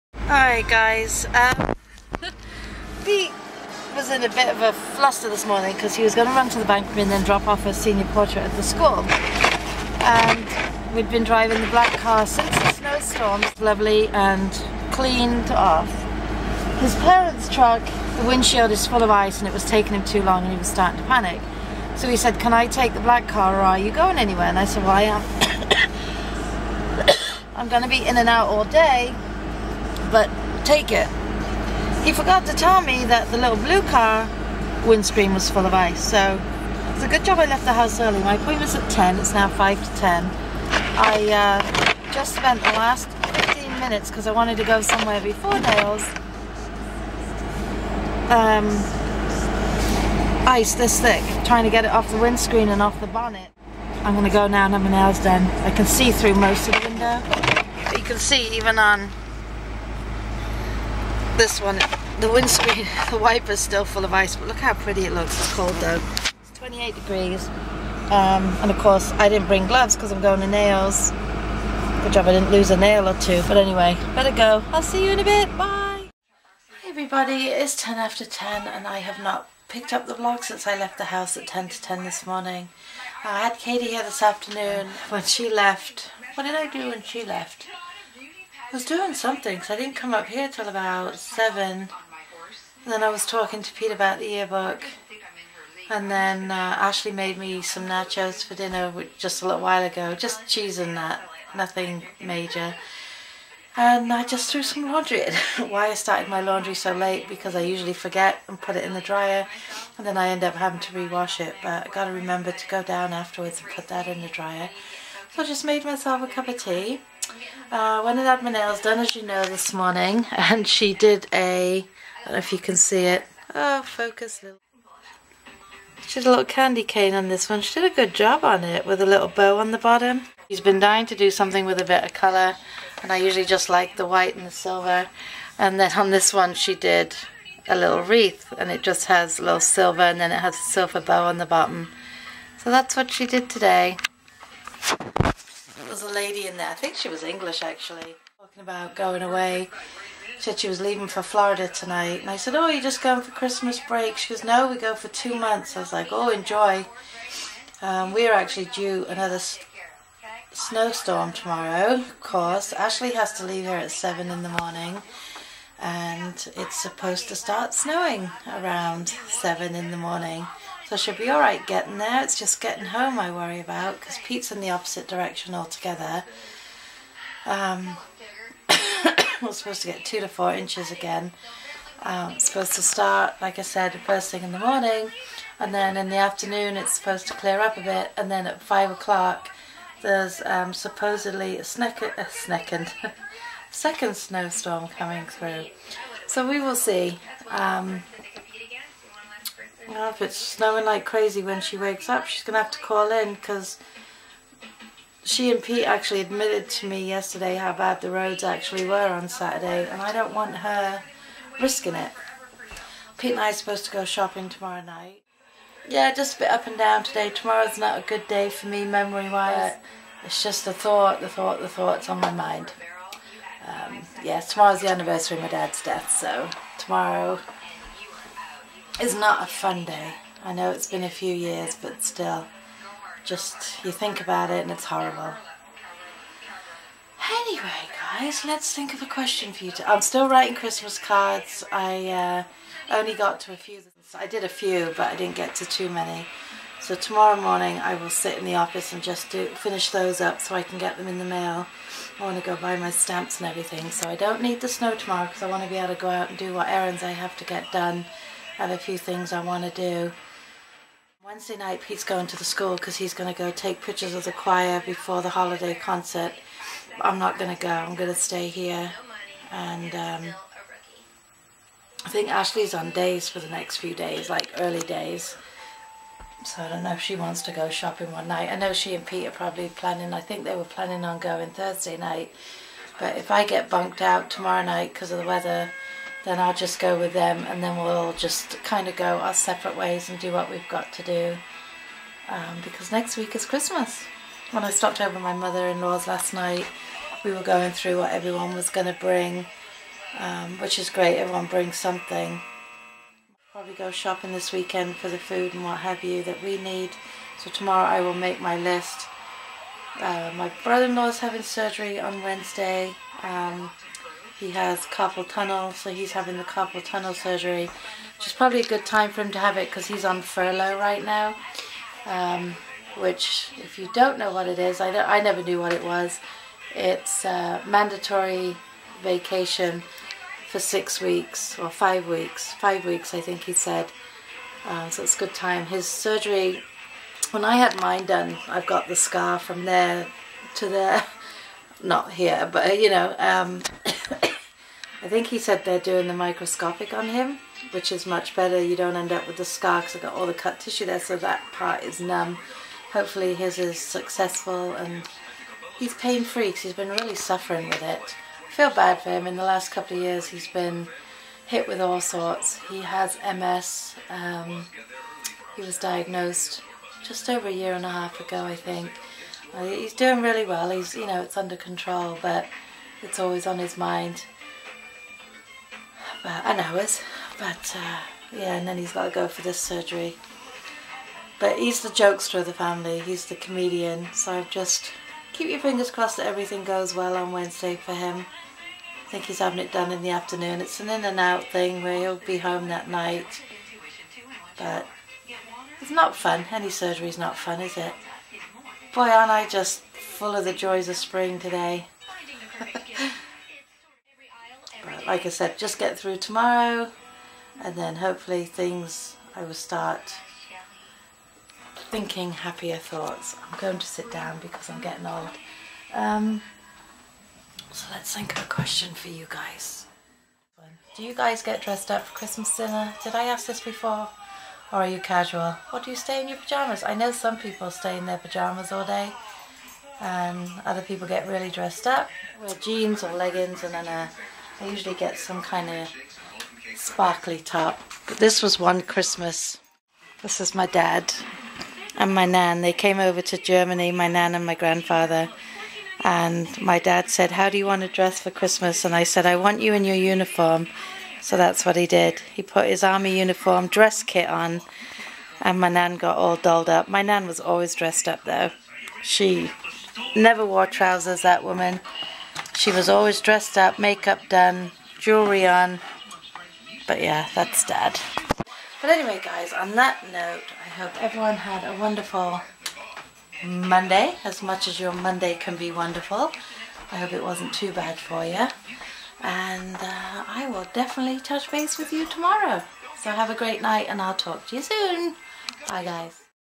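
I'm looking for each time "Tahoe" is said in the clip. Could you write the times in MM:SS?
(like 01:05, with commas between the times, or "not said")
not said.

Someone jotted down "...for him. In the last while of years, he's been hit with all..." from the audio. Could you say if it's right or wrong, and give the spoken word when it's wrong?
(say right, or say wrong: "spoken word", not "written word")
wrong: "couple", not "while".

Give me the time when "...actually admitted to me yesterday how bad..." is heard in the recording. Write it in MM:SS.
03:25.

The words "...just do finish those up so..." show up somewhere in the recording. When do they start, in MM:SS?
04:09.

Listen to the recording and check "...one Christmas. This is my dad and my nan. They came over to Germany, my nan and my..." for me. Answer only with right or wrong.
right.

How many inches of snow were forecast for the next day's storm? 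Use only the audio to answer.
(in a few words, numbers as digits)
2 to 4 inches.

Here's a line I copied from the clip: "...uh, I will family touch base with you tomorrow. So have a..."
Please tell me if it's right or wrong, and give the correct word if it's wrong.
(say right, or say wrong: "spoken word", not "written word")
wrong: "definitely", not "family".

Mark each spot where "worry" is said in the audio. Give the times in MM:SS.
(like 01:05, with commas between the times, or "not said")
02:53.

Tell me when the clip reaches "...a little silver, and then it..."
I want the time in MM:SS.
02:19.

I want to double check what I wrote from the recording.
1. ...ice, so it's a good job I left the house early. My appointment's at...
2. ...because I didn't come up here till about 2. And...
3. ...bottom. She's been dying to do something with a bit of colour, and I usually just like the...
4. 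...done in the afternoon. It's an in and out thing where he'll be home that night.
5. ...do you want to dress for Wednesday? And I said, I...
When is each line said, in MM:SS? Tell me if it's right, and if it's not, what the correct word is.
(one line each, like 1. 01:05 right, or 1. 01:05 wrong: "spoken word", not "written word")
1. 00:35 right
2. 01:29 wrong: "7", not "2"
3. 02:09 right
4. 06:29 right
5. 07:27 wrong: "Christmas", not "Wednesday".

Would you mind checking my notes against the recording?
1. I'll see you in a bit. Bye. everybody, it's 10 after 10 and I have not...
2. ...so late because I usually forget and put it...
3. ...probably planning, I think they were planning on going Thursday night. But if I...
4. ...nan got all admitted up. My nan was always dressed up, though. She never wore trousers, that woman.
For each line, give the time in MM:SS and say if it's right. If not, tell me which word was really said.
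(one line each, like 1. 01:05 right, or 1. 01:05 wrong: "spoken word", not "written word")
1. 01:14 right
2. 01:46 right
3. 04:39 right
4. 07:35 wrong: "dolled", not "admitted".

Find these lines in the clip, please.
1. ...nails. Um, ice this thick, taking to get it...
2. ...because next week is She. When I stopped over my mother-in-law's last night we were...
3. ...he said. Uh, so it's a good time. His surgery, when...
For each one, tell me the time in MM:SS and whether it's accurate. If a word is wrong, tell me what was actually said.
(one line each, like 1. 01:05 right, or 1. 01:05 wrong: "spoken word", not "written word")
1. 00:45 wrong: "trying", not "taking"
2. 04:52 wrong: "Christmas", not "She"
3. 05:33 right.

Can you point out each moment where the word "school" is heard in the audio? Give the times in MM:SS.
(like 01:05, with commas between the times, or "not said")
00:08, 04:22.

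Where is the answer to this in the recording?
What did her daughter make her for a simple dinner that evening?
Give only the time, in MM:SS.
01:37.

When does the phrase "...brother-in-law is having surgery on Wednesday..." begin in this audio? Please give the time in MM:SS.
05:10.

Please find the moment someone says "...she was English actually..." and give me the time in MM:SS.
02:26.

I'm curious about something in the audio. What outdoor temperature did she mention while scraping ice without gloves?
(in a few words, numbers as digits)
28 degrees.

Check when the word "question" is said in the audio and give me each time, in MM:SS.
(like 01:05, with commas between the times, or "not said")
03:59, 06:58.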